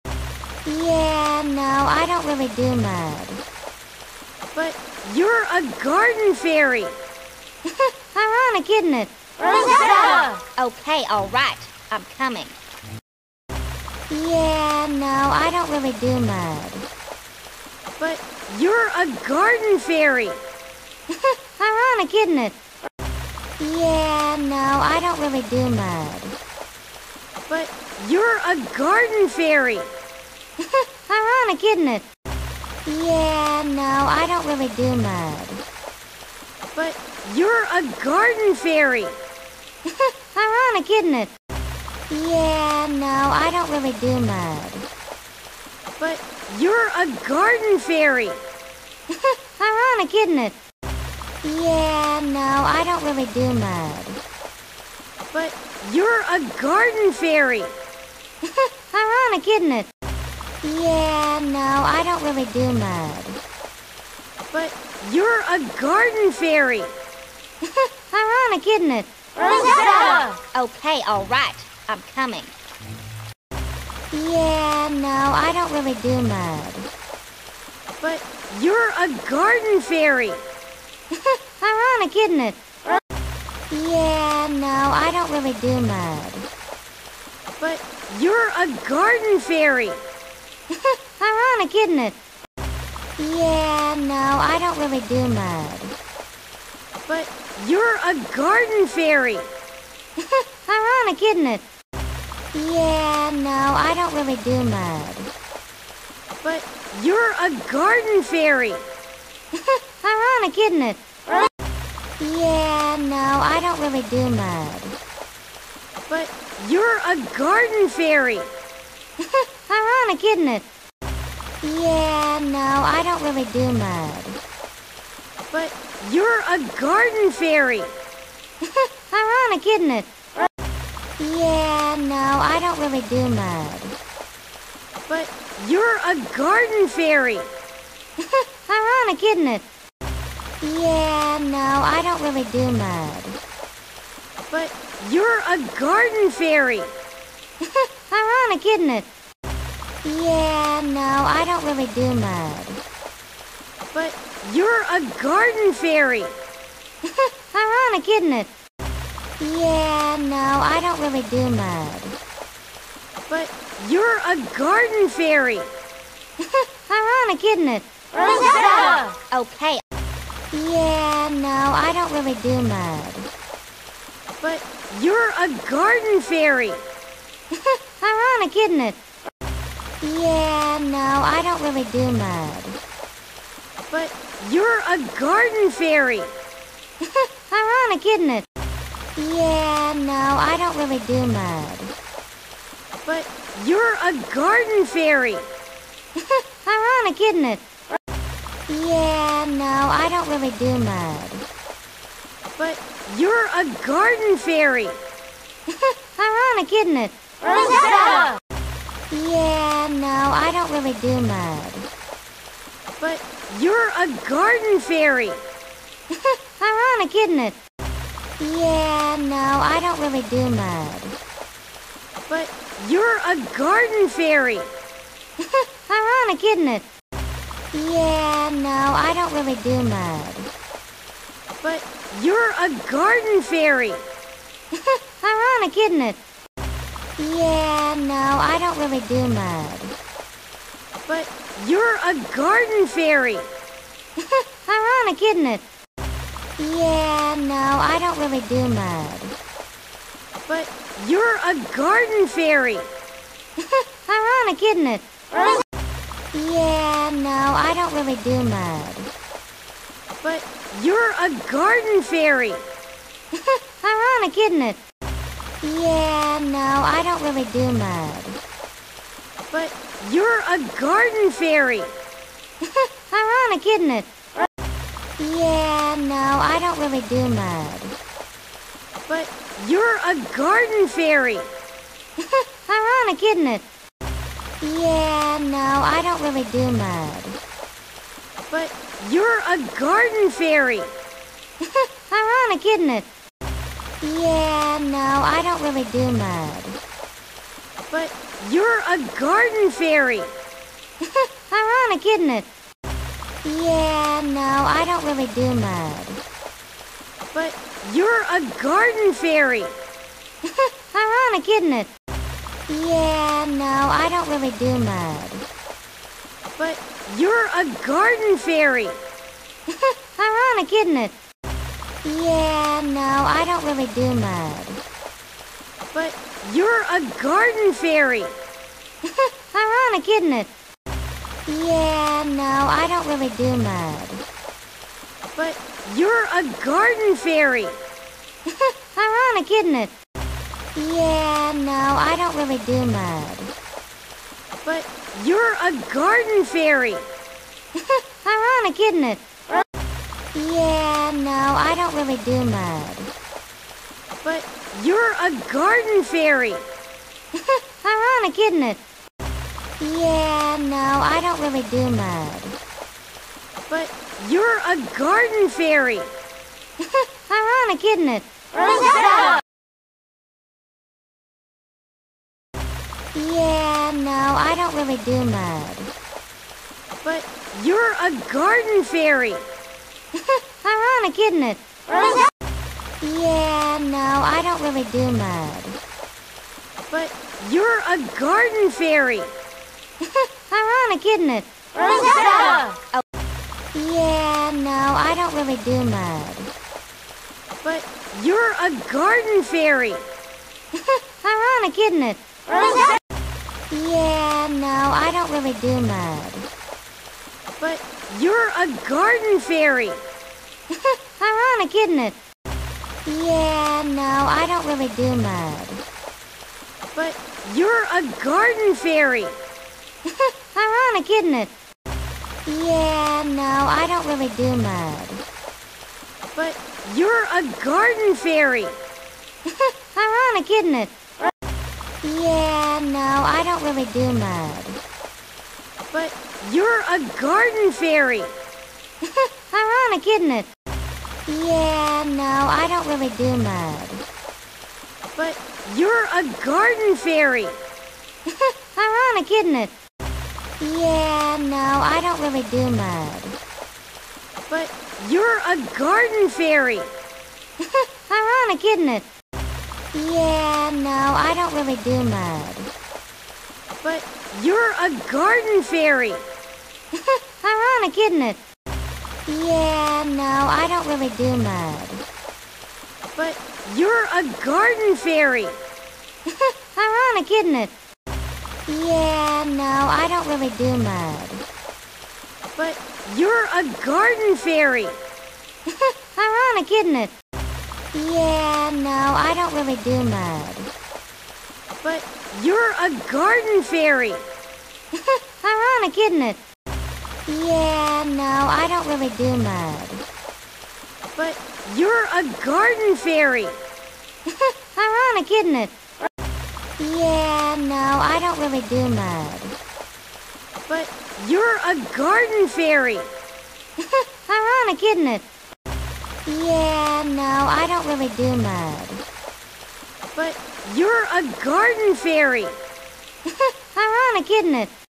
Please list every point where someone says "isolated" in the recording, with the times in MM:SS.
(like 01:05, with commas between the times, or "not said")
not said.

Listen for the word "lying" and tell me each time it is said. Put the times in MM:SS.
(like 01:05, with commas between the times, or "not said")
not said.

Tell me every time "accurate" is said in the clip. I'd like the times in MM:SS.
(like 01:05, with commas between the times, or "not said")
not said.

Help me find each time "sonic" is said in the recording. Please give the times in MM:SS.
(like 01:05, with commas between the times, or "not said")
02:28.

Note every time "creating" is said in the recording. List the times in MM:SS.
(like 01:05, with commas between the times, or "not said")
not said.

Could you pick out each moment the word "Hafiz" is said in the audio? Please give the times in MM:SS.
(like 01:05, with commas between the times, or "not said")
not said.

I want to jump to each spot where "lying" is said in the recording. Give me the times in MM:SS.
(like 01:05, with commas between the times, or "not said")
not said.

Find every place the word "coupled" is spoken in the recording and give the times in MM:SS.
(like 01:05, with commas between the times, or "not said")
not said.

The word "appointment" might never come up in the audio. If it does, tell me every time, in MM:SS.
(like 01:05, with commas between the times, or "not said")
not said.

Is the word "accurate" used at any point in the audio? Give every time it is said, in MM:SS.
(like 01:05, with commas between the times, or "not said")
not said.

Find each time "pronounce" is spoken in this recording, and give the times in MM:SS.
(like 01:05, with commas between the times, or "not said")
not said.